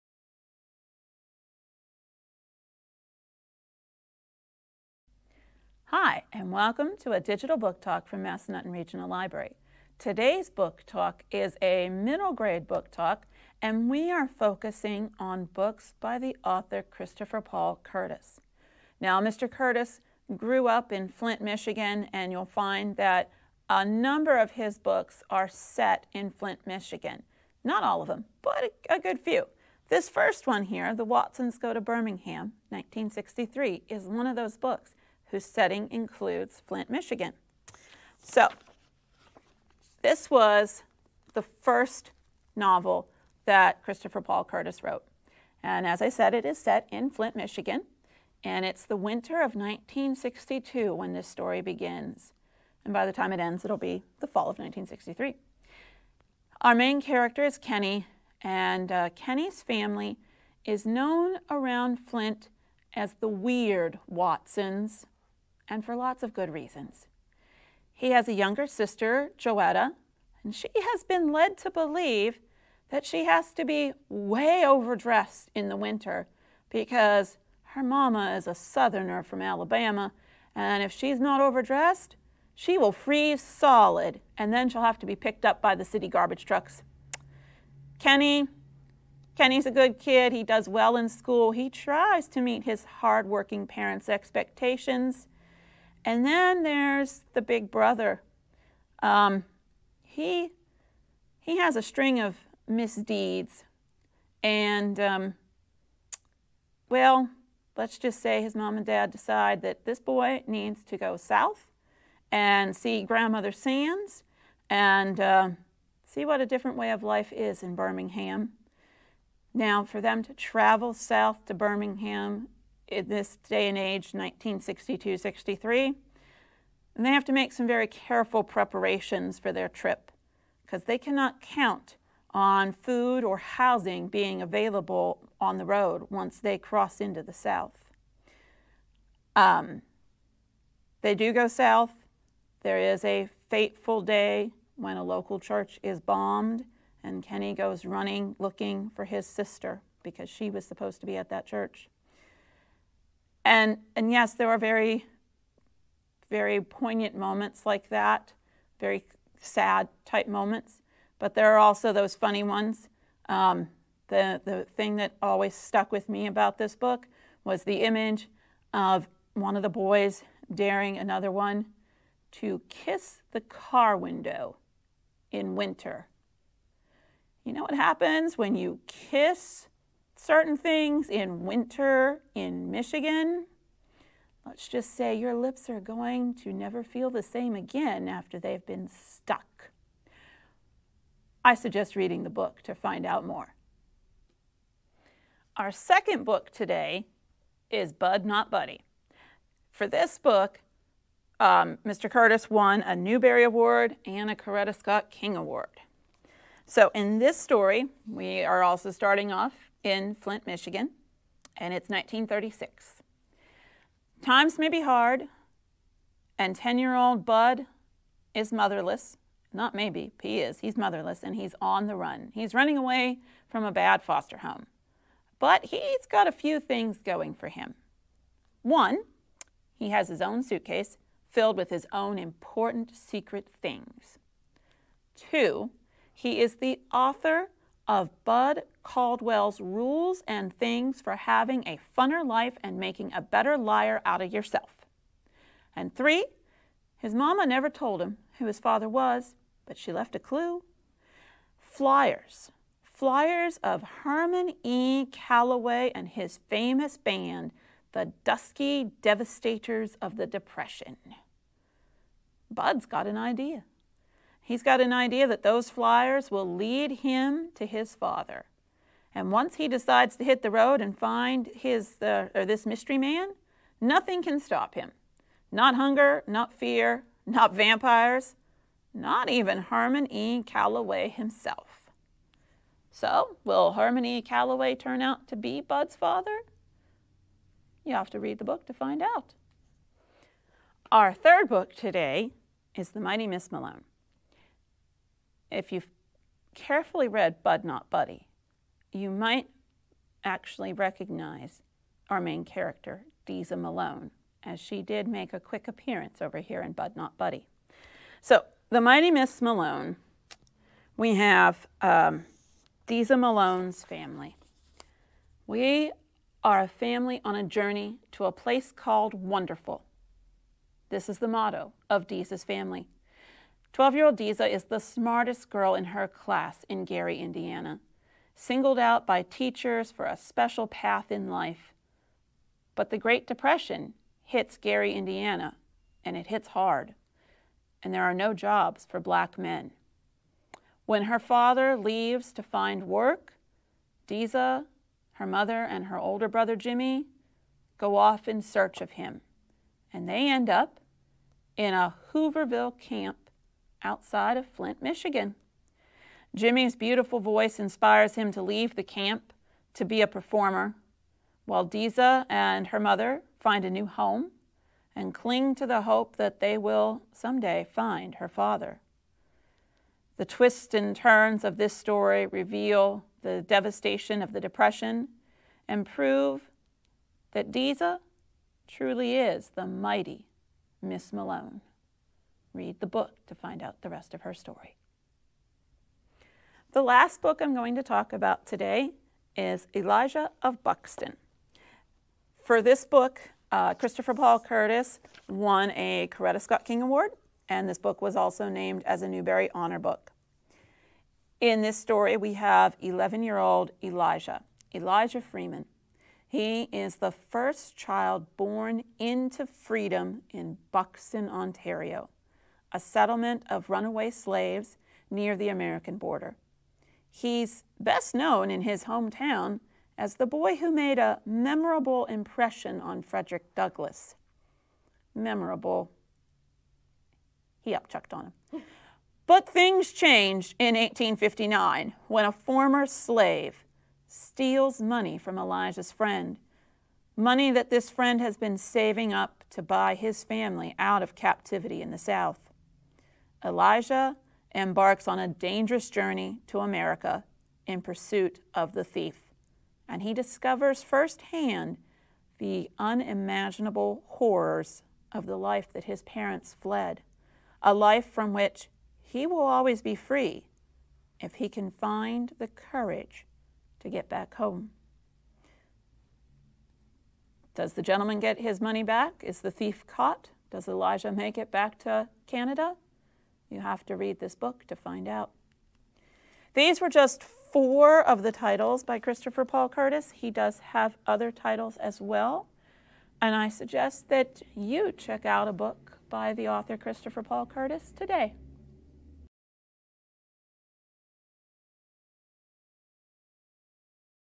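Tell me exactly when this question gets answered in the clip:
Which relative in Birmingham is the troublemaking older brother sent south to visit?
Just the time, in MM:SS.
01:53.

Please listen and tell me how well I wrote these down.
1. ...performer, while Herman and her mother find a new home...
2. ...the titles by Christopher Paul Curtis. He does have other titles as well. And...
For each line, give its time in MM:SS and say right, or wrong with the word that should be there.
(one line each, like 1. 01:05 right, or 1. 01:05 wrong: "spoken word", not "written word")
1. 06:00 wrong: "Deza", not "Herman"
2. 07:58 right.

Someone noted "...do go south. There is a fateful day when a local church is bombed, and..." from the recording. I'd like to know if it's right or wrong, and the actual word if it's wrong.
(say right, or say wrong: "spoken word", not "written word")
right.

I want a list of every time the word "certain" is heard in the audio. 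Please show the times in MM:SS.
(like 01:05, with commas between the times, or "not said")
03:00.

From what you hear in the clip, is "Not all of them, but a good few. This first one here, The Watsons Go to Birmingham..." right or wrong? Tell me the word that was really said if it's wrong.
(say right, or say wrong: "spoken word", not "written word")
right.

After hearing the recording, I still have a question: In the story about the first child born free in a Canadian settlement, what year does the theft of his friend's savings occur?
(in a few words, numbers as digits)
1859.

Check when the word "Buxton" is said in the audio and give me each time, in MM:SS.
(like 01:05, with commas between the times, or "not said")
06:30, 06:50.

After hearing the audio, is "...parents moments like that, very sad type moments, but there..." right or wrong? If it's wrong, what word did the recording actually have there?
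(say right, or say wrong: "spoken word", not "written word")
wrong: "poignant", not "parents".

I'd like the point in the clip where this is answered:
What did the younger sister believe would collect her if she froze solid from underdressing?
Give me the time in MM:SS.
01:25.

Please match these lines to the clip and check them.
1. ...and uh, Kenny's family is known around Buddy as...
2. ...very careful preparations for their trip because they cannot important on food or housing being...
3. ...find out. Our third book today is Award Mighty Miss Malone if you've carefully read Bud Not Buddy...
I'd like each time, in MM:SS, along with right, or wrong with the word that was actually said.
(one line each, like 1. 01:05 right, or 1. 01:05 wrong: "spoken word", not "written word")
1. 00:58 wrong: "Flint", not "Buddy"
2. 02:07 wrong: "count", not "important"
3. 04:48 wrong: "The", not "Award".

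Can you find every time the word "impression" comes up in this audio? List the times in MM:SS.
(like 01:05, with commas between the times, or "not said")
07:02.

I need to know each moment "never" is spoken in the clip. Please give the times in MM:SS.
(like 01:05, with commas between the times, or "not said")
03:06, 04:07.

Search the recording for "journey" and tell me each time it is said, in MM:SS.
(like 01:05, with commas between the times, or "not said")
05:17, 07:25.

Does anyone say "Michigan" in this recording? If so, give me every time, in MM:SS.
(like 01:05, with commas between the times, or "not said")
00:21, 00:26, 00:36, 00:47, 03:02, 03:30, 05:54.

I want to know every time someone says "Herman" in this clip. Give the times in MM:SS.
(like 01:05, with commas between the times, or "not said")
04:14, 04:39, 04:43.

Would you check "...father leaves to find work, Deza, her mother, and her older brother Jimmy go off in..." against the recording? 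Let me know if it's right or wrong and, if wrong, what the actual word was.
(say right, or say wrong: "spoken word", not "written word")
right.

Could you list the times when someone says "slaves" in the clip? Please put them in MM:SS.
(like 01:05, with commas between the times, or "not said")
06:54, 07:12.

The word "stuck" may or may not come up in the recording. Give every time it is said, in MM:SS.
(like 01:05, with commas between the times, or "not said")
02:45, 03:08.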